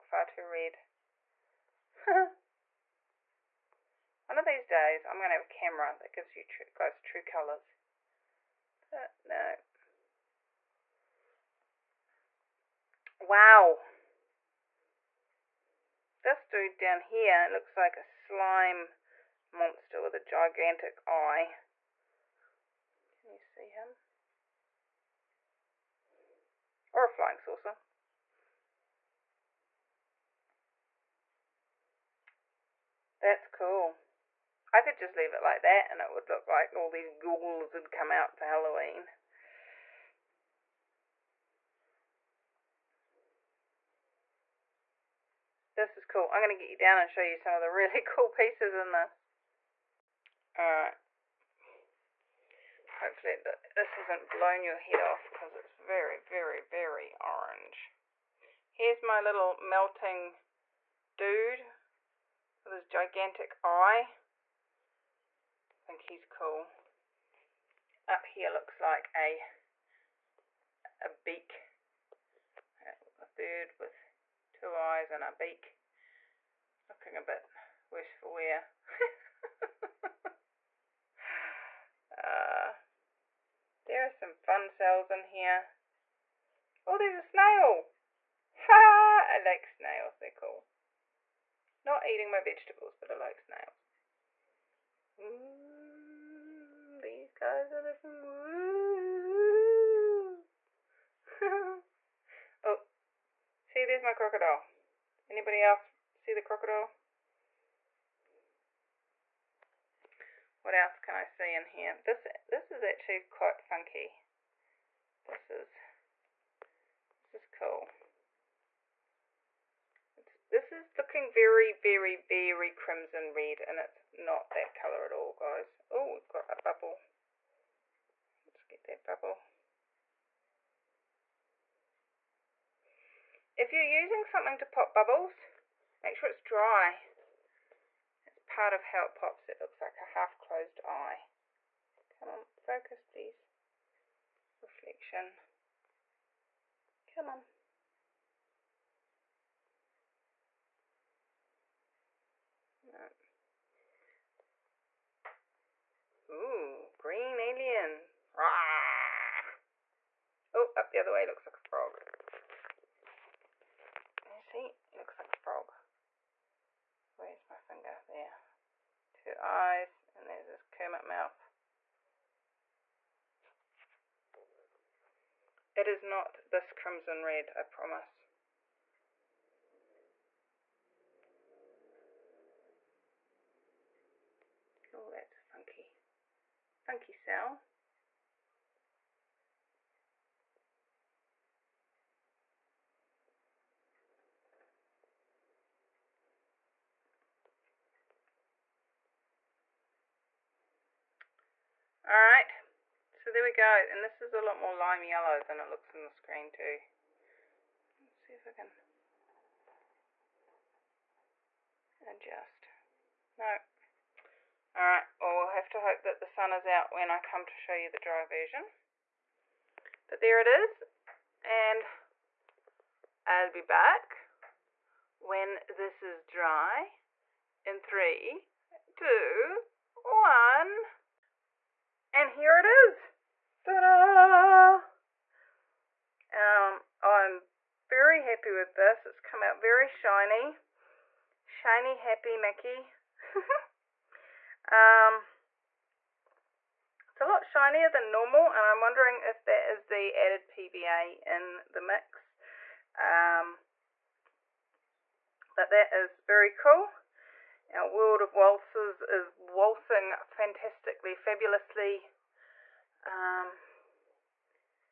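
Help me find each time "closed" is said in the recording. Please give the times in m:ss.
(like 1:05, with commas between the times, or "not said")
2:20.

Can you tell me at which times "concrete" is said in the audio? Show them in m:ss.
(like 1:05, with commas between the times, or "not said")
not said.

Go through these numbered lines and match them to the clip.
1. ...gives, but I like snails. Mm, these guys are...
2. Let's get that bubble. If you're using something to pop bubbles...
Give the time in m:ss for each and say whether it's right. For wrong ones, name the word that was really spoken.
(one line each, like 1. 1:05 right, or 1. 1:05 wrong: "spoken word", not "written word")
1. 1:32 wrong: "vegetables", not "gives"
2. 2:08 right.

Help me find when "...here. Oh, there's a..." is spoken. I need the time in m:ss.
1:25.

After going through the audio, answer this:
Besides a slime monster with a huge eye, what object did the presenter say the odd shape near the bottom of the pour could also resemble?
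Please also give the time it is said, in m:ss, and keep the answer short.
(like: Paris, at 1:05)
Flying saucer, at 0:27.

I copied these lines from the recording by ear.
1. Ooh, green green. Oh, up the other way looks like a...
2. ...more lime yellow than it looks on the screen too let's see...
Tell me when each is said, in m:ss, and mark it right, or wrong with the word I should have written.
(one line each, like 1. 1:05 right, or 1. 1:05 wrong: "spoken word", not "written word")
1. 2:36 wrong: "alien", not "green"
2. 3:24 right.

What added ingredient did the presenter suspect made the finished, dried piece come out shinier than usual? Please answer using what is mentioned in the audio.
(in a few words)
PVA.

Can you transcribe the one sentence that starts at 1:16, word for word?
Looking a bit worse for wear.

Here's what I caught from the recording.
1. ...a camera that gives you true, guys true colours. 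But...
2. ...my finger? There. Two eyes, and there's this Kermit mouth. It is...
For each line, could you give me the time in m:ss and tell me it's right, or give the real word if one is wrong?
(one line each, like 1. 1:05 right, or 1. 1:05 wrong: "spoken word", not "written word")
1. 0:05 right
2. 2:47 right.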